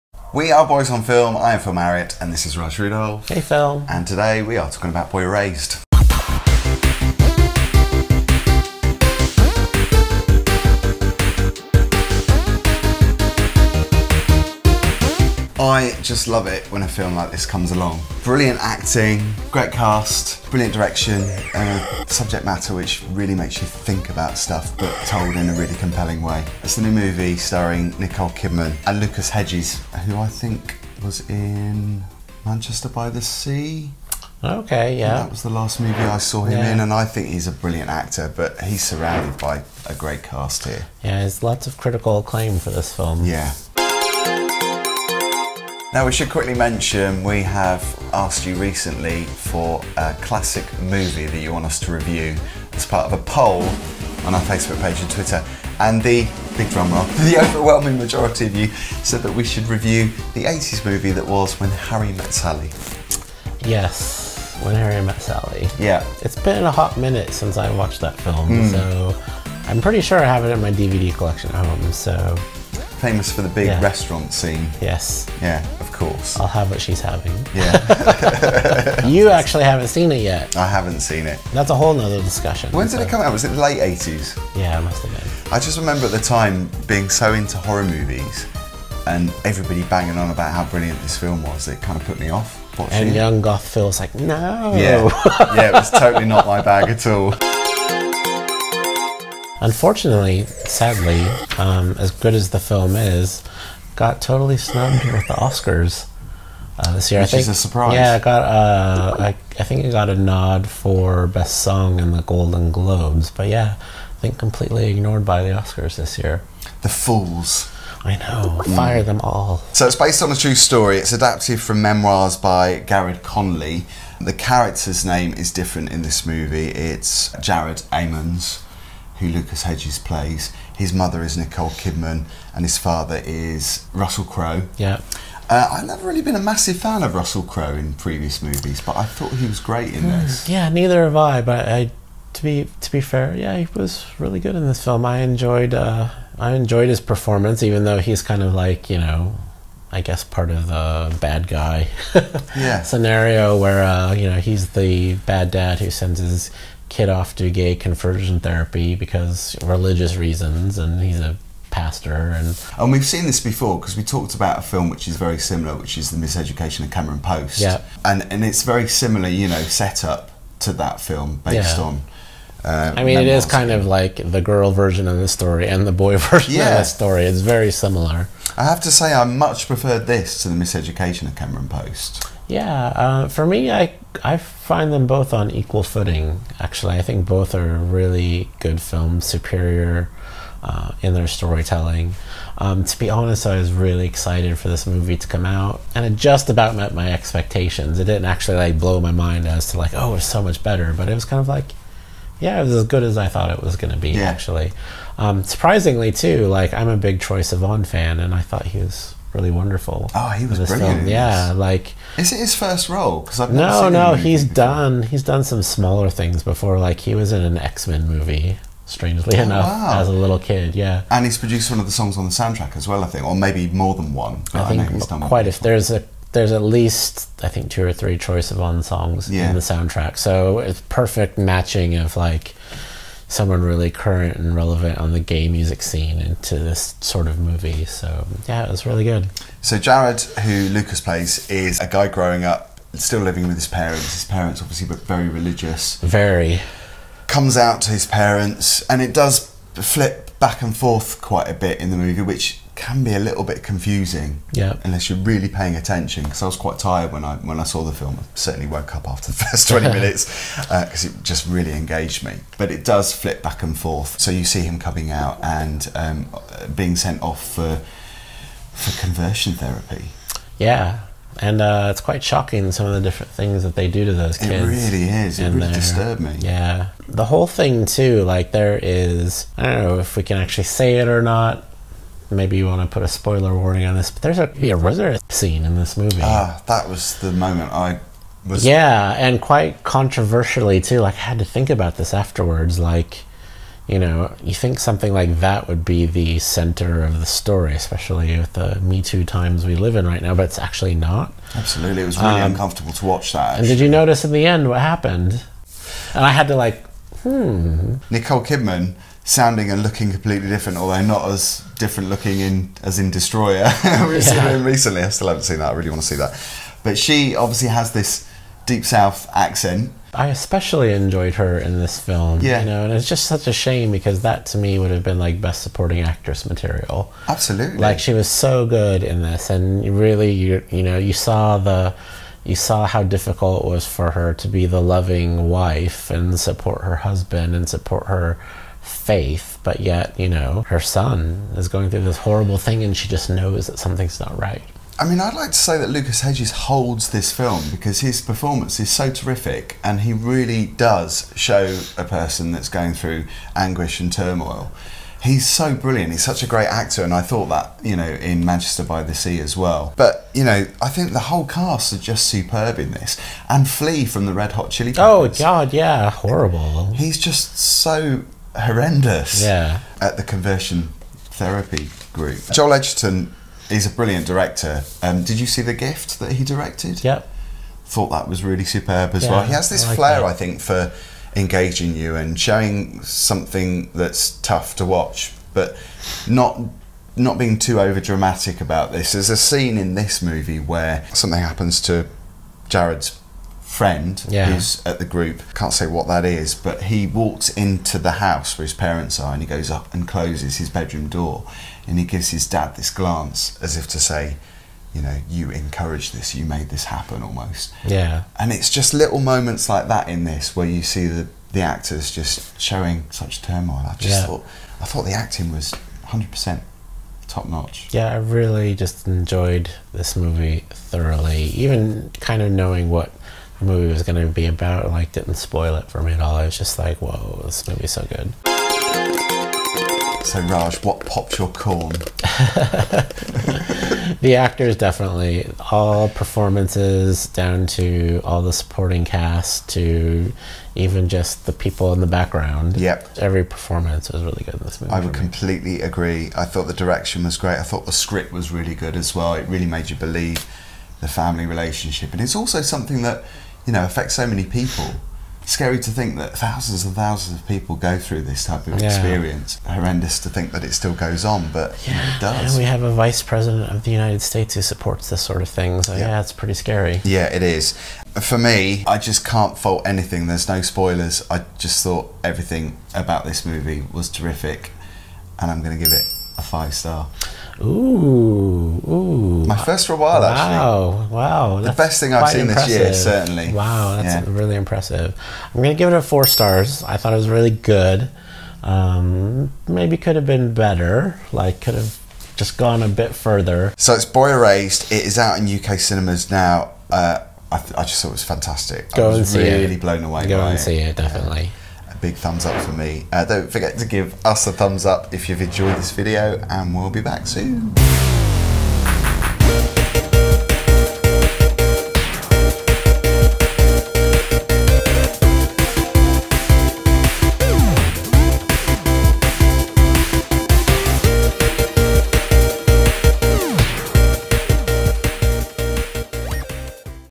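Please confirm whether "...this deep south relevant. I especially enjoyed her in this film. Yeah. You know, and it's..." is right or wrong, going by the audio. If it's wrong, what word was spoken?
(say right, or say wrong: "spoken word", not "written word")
wrong: "accent", not "relevant".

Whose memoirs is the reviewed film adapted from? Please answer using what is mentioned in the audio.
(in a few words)
Garrard Conley.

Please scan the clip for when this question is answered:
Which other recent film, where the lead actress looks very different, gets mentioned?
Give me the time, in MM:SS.
05:13.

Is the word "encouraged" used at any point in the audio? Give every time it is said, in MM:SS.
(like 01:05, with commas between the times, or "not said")
06:45.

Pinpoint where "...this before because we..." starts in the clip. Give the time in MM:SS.
02:43.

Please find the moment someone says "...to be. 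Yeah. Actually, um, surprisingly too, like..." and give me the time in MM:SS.
03:23.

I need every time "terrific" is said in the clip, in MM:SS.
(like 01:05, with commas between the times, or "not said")
05:49, 07:54.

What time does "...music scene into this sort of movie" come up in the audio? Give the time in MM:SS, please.
03:55.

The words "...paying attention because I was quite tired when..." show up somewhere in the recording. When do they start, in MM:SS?
04:15.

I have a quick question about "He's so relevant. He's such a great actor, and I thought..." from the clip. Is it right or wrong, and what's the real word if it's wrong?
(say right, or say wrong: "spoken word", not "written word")
wrong: "brilliant", not "relevant".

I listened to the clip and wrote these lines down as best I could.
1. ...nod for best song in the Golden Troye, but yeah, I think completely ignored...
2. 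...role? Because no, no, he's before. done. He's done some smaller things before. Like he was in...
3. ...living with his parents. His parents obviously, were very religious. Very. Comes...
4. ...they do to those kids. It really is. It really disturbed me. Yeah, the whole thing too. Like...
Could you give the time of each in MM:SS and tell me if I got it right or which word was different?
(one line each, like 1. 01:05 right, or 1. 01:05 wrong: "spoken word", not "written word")
1. 01:50 wrong: "Globes", not "Troye"
2. 03:32 right
3. 04:03 right
4. 04:33 right.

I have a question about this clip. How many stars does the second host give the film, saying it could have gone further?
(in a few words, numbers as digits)
4.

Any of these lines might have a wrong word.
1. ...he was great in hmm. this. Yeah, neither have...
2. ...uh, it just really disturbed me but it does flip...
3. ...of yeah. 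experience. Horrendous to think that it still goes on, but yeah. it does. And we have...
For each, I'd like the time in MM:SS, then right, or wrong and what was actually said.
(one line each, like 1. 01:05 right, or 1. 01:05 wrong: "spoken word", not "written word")
1. 02:19 right
2. 04:21 wrong: "engaged", not "disturbed"
3. 07:38 right.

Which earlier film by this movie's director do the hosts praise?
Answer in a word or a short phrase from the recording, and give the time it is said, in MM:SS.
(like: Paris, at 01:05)
The Gift, at 06:15.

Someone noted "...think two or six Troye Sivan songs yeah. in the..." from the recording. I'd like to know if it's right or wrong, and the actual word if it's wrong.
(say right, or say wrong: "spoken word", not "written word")
wrong: "three", not "six".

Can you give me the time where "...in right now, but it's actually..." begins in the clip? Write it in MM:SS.
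04:59.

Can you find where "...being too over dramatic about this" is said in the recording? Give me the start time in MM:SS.
06:27.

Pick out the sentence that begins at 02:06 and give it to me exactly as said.
It's Jared Eamons who Lucas Hedges plays.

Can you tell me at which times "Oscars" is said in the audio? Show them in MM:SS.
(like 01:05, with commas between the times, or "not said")
01:45, 01:55.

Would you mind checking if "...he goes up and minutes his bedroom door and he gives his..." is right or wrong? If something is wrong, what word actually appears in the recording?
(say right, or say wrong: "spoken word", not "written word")
wrong: "closes", not "minutes".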